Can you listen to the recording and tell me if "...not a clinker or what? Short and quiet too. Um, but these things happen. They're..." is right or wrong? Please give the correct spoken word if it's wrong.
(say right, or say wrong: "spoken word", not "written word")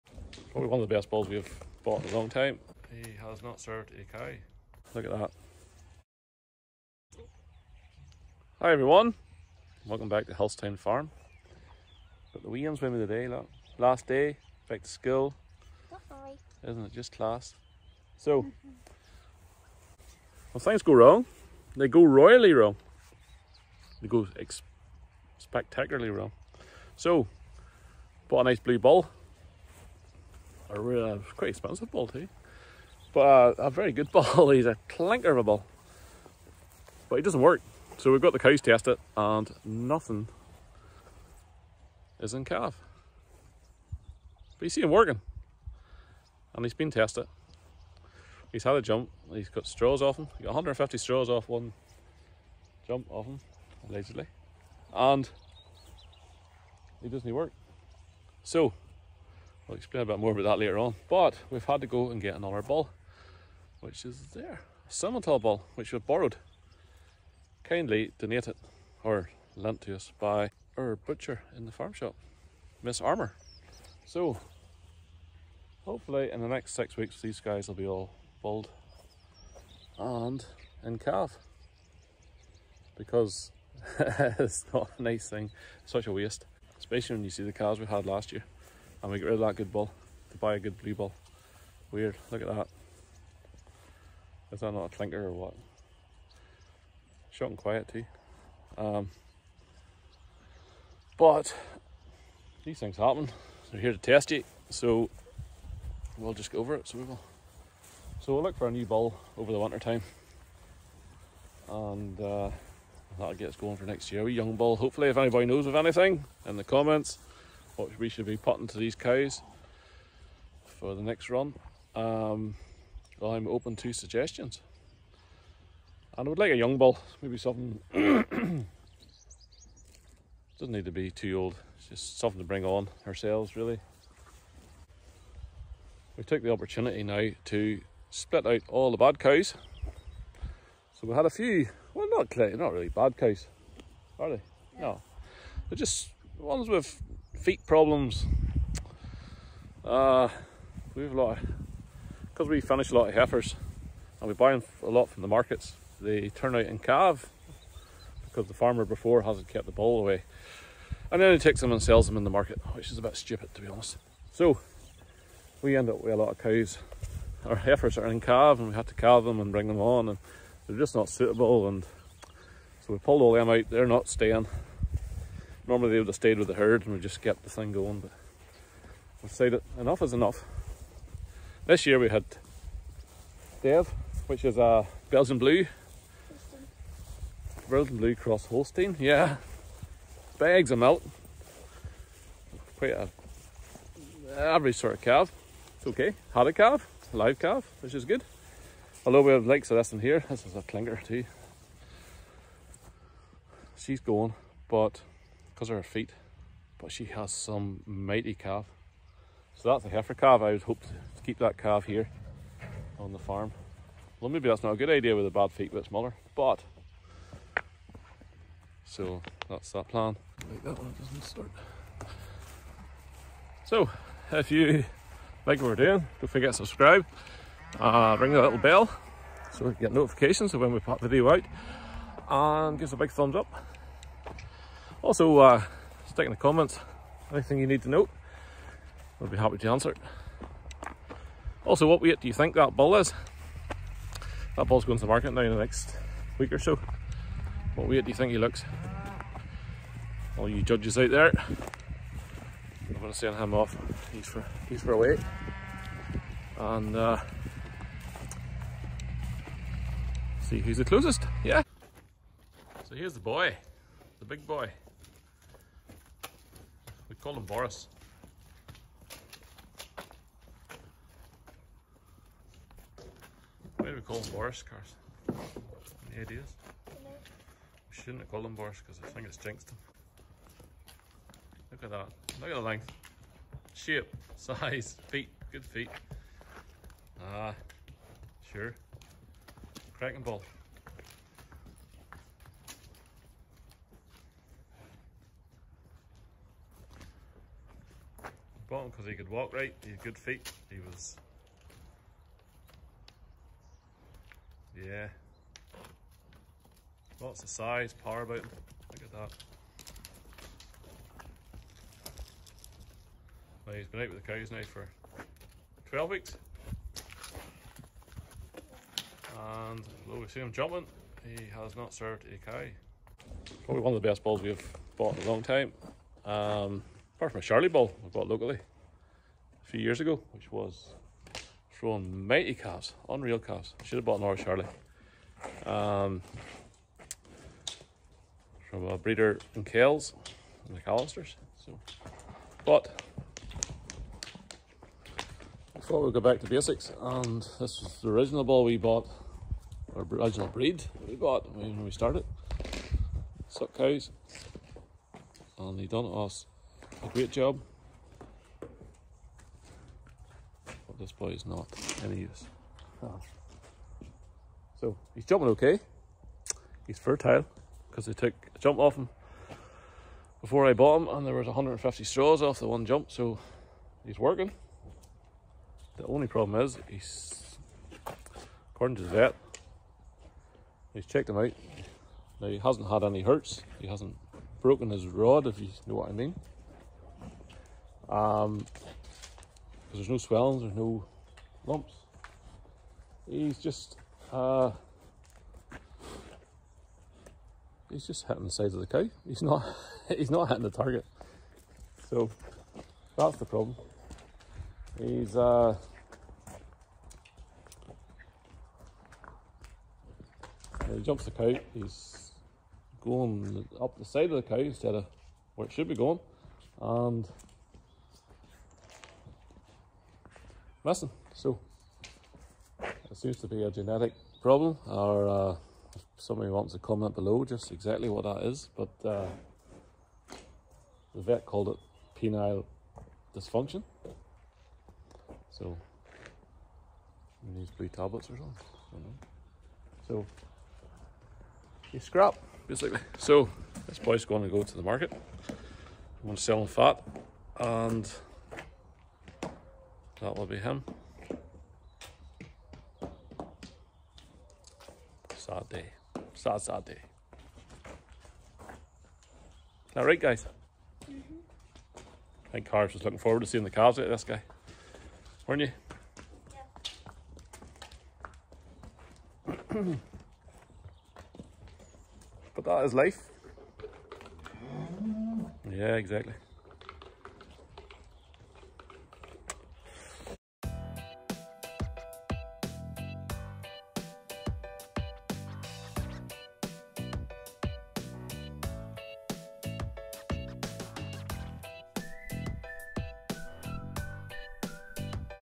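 right.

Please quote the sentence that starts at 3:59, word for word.
I'll be happy to answer it.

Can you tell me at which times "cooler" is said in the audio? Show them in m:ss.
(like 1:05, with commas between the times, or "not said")
not said.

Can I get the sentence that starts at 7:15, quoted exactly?
So he needs blue tablets or something.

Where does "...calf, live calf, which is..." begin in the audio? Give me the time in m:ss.
3:16.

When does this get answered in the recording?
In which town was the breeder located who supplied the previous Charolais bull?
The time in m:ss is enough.
5:39.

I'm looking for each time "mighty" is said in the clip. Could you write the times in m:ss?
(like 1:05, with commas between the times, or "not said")
3:27, 5:32.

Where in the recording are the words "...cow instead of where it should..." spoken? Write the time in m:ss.
6:54.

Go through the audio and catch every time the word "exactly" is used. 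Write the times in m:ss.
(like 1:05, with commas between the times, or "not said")
7:07, 7:55.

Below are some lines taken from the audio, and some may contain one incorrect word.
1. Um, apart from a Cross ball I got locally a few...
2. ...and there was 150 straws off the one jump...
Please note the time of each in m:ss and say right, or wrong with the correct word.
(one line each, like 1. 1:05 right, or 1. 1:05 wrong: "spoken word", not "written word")
1. 5:26 wrong: "Charolais", not "Cross"
2. 6:11 right.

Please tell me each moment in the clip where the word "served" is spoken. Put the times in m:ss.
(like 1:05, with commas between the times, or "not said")
0:03, 5:21.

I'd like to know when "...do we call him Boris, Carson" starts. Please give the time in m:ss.
4:33.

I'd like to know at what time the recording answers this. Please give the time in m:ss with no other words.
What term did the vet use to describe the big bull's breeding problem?
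7:12.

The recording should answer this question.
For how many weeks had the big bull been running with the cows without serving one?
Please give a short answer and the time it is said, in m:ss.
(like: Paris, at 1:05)
12, at 5:15.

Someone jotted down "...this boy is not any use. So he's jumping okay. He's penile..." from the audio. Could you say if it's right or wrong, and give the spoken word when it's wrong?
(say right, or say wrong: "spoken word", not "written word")
wrong: "fertile", not "penile".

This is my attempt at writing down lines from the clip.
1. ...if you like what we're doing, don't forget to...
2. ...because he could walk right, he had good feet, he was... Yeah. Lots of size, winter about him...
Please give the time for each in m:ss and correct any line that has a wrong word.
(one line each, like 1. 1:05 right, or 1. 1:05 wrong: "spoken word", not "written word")
1. 3:44 right
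2. 4:58 wrong: "power", not "winter".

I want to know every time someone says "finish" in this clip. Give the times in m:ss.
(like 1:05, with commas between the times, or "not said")
2:32.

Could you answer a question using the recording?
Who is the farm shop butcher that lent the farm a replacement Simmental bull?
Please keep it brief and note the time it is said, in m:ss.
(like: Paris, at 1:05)
Miss Armour, at 1:12.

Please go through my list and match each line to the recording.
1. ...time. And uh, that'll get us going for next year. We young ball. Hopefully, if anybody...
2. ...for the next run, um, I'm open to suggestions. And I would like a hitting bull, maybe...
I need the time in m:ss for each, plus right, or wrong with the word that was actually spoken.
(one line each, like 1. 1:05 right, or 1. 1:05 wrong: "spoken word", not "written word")
1. 1:49 right
2. 2:00 wrong: "young", not "hitting".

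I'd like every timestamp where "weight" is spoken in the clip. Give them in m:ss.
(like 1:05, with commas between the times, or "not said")
4:02, 4:07, 4:14.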